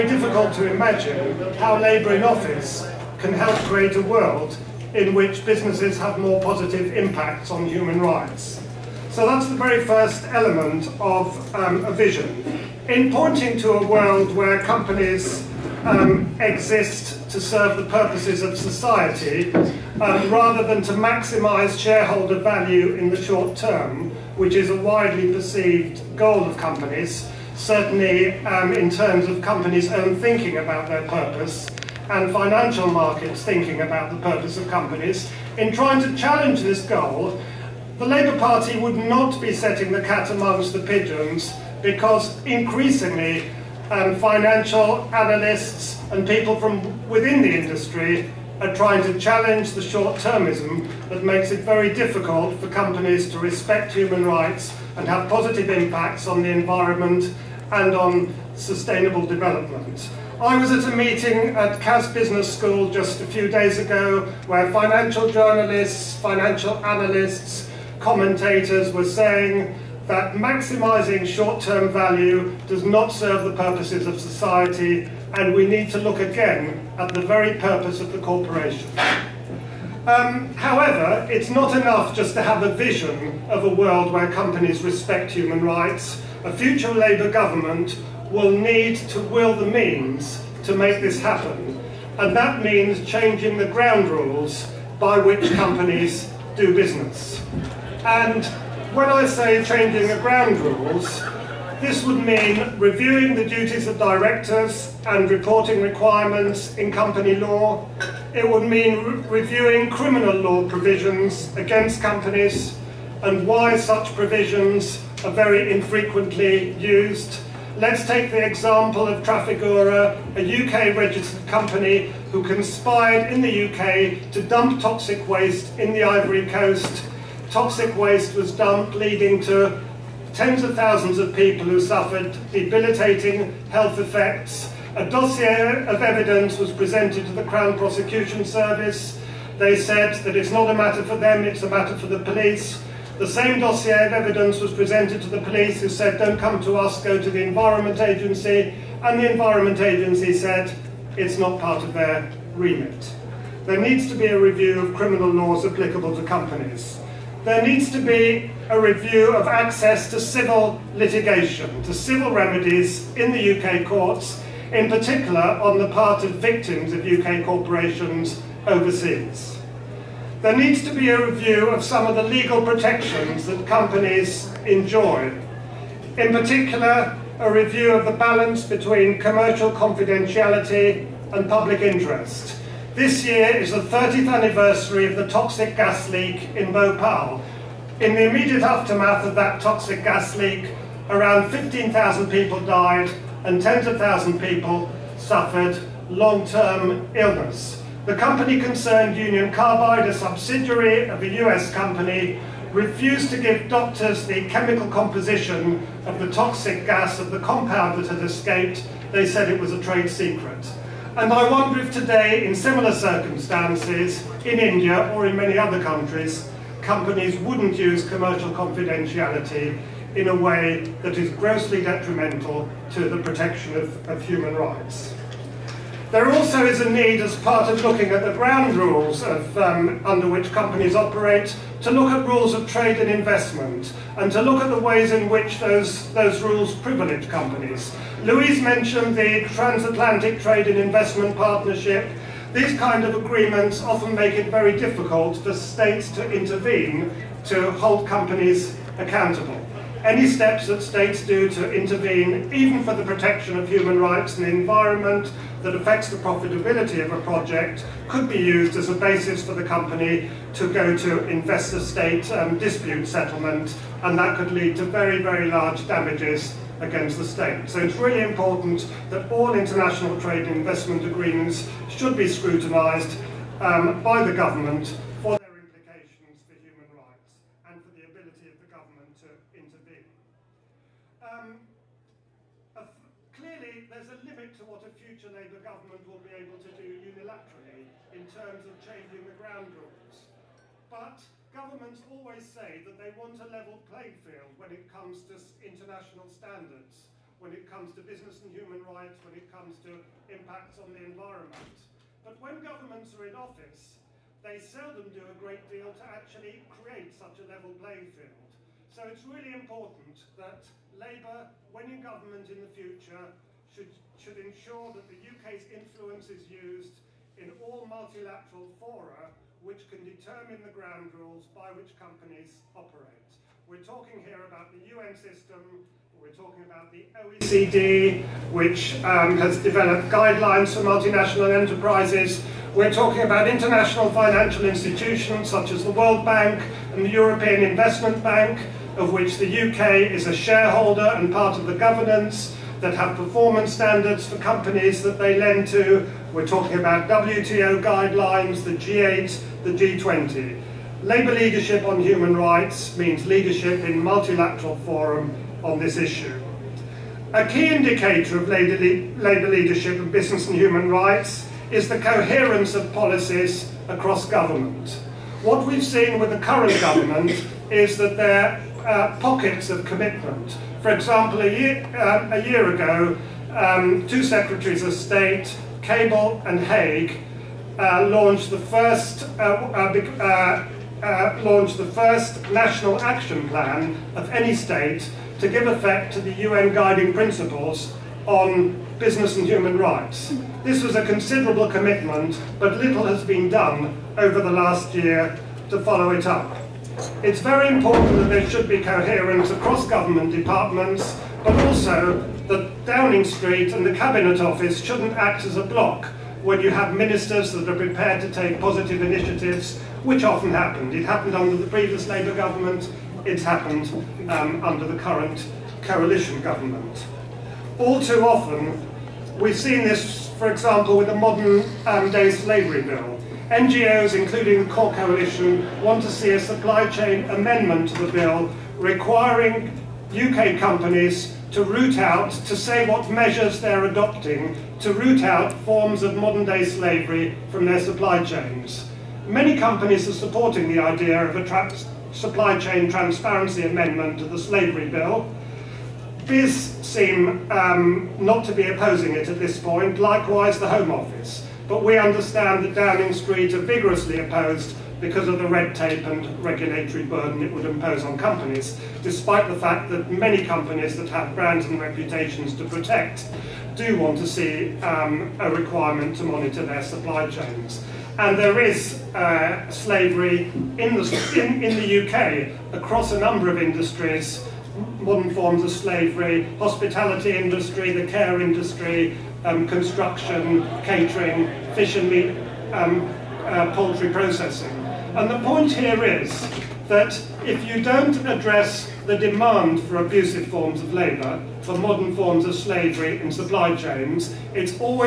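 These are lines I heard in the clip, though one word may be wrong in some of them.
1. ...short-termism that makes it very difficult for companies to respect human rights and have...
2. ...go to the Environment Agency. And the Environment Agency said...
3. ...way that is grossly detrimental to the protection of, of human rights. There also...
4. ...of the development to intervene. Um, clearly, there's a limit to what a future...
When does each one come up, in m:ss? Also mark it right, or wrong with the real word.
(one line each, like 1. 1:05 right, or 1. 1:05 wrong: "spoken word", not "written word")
1. 0:49 right
2. 2:27 right
3. 3:40 right
4. 4:38 wrong: "government", not "development".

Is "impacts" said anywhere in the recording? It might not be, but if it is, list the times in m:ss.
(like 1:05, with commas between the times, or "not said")
0:06, 0:55, 5:00.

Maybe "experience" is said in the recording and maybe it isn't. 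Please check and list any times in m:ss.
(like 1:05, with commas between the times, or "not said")
not said.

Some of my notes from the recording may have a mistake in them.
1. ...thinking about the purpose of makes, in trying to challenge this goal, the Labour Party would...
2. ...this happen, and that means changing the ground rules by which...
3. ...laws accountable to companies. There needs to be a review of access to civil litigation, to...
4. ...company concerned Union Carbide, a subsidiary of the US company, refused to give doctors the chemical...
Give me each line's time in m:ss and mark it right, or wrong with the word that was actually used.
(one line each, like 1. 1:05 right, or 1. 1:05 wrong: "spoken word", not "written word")
1. 0:33 wrong: "companies", not "makes"
2. 1:30 right
3. 2:35 wrong: "applicable", not "accountable"
4. 3:18 right.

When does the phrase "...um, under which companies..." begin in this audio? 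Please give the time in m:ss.
3:49.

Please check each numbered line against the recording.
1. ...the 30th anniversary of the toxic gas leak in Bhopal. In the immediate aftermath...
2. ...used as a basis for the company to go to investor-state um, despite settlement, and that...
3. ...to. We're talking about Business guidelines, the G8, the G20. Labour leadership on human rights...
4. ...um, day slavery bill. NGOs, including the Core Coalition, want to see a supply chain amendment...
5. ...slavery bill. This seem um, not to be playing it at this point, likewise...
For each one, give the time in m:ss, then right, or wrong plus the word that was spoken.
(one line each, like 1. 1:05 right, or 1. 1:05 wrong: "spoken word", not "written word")
1. 3:03 right
2. 4:18 wrong: "dispute", not "despite"
3. 5:45 wrong: "WTO", not "Business"
4. 7:01 right
5. 7:24 wrong: "opposing", not "playing".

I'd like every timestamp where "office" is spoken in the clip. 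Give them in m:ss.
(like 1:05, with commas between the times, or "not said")
0:02, 5:03, 6:44, 7:30.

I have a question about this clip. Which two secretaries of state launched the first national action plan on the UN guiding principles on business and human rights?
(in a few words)
Cable and Hague.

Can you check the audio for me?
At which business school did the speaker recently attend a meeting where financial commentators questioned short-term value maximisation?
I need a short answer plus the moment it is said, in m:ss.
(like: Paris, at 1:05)
Cass Business School, at 1:01.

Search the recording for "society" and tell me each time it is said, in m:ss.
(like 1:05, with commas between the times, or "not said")
0:18, 1:14.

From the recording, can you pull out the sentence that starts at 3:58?
Louise mentioned the transatlantic trade and investment partnership.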